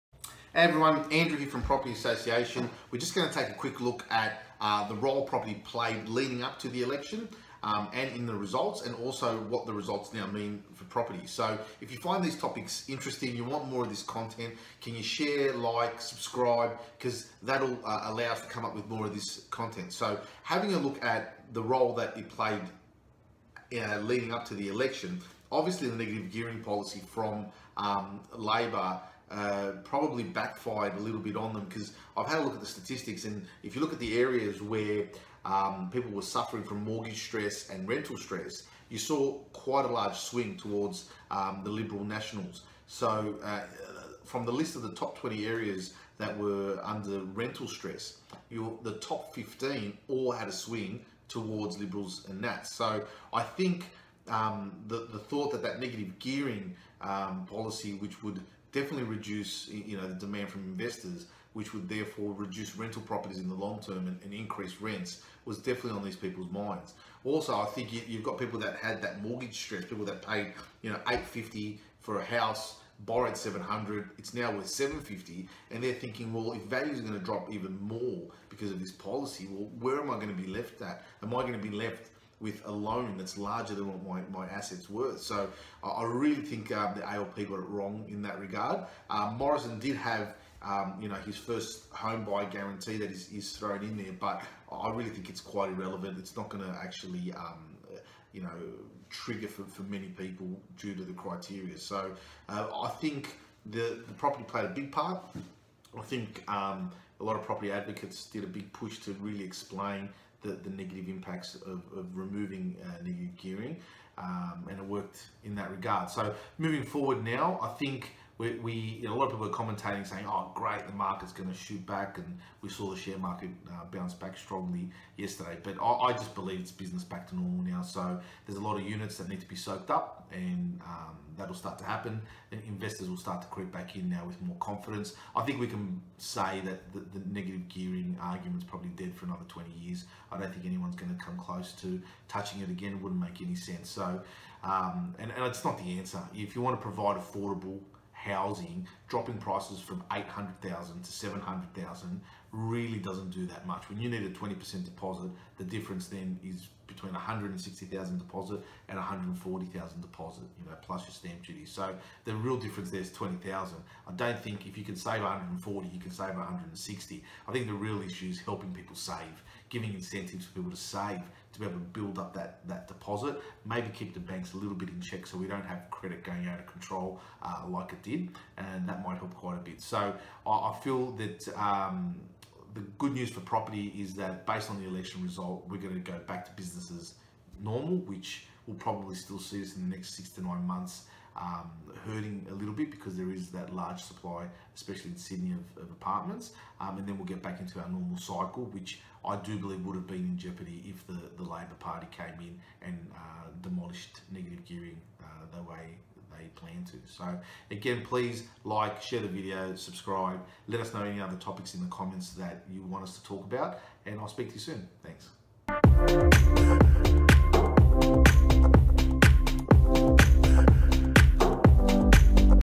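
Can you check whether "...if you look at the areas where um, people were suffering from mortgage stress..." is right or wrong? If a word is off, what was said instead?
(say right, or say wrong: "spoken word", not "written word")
right.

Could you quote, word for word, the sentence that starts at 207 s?
So again, please like, share the video, subscribe.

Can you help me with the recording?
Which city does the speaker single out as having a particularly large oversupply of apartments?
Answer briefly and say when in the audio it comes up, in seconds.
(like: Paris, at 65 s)
Sydney, at 195 s.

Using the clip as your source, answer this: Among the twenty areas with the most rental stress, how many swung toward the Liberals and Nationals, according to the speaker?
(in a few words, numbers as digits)
15.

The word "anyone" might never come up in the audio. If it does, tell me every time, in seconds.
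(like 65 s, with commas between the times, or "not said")
140 s.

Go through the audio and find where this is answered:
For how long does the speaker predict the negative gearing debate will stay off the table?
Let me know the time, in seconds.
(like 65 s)
139 s.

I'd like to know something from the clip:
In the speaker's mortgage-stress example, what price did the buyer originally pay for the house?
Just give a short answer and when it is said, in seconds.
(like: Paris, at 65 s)
850, at 71 s.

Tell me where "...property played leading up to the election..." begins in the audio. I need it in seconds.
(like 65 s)
5 s.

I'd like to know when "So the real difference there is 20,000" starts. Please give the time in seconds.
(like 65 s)
161 s.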